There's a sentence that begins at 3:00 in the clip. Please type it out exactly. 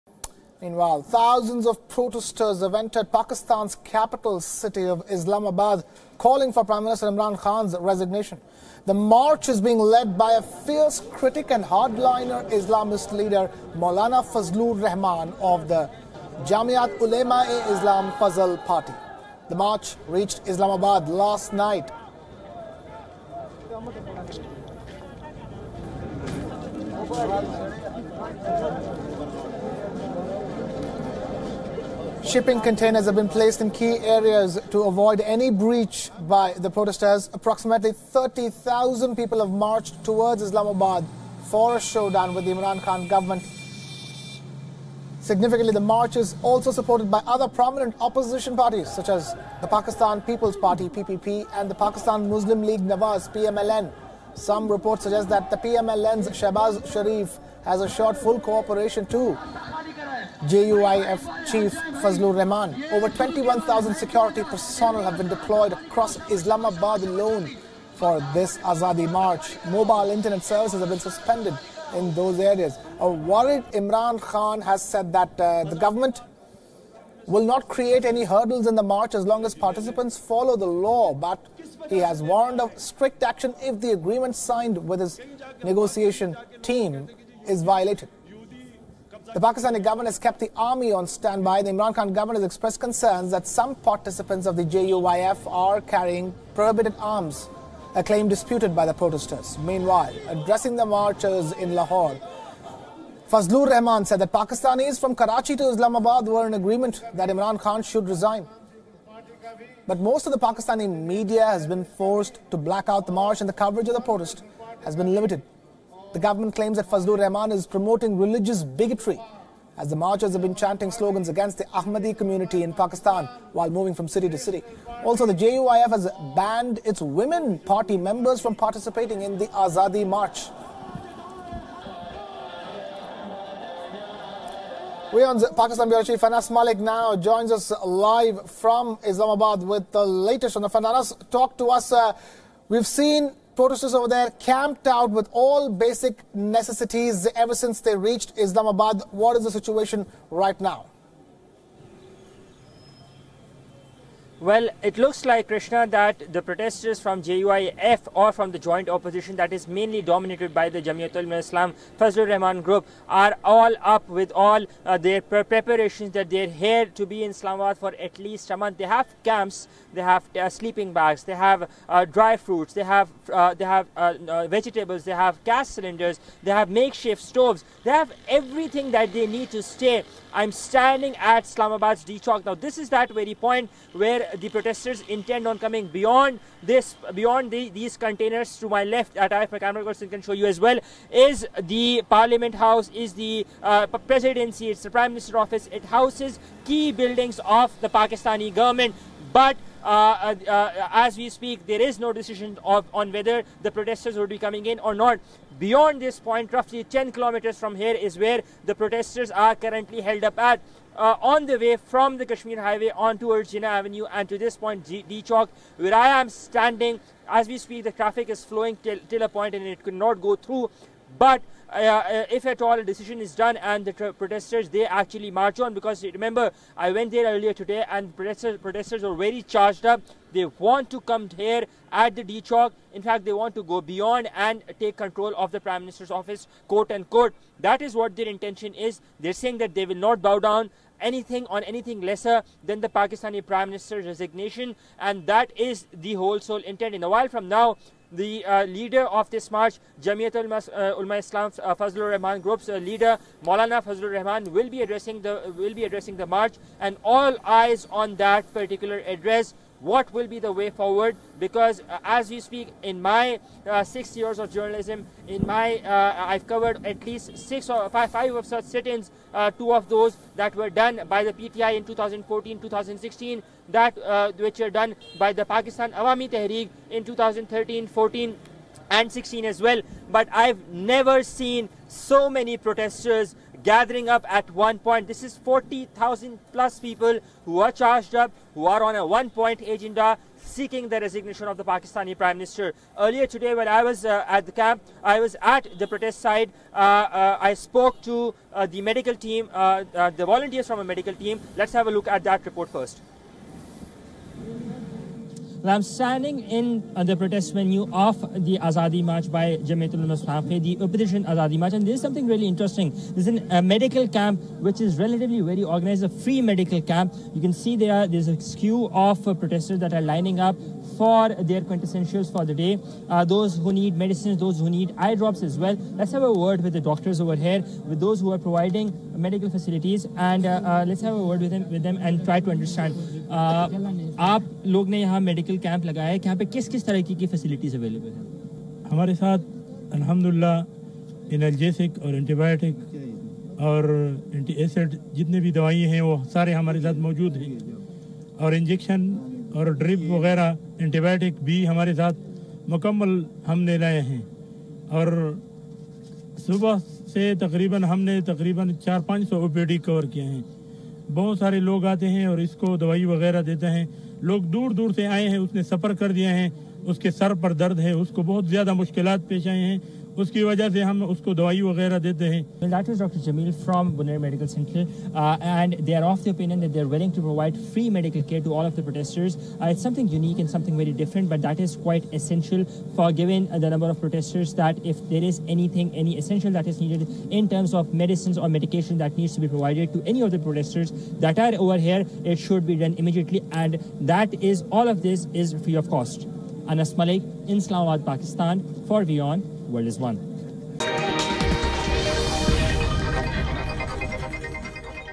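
I'm standing at Islamabad's D Chowk.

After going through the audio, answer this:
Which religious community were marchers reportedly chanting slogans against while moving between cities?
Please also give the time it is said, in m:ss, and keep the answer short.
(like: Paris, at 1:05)
Ahmadi community, at 2:01.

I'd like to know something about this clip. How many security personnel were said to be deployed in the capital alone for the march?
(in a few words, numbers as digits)
Over 21,000.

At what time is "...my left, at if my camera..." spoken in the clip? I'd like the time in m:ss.
3:08.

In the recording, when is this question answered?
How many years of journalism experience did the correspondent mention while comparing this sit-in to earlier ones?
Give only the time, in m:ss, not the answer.
4:23.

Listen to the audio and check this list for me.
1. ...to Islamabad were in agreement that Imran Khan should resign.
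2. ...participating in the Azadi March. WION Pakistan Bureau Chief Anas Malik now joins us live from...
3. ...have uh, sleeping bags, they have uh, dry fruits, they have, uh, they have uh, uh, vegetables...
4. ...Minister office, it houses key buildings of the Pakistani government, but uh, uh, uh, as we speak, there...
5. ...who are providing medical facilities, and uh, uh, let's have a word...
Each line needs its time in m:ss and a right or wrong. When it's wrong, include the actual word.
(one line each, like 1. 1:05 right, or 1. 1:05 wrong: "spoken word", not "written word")
1. 1:45 right
2. 2:08 right
3. 2:50 right
4. 3:15 right
5. 5:28 right.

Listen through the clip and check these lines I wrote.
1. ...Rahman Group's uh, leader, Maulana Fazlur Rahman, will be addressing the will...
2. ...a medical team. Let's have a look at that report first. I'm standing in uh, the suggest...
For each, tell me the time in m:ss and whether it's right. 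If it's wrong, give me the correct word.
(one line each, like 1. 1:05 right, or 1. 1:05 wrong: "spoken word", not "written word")
1. 4:12 right
2. 5:00 wrong: "protest", not "suggest".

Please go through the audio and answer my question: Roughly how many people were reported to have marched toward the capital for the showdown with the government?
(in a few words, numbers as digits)
30,000.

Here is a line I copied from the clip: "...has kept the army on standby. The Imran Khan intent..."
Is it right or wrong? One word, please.
wrong.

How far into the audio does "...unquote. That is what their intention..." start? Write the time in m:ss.
3:56.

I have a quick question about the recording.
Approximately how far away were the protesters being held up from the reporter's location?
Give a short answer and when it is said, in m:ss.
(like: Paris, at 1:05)
10 kilometers, at 3:26.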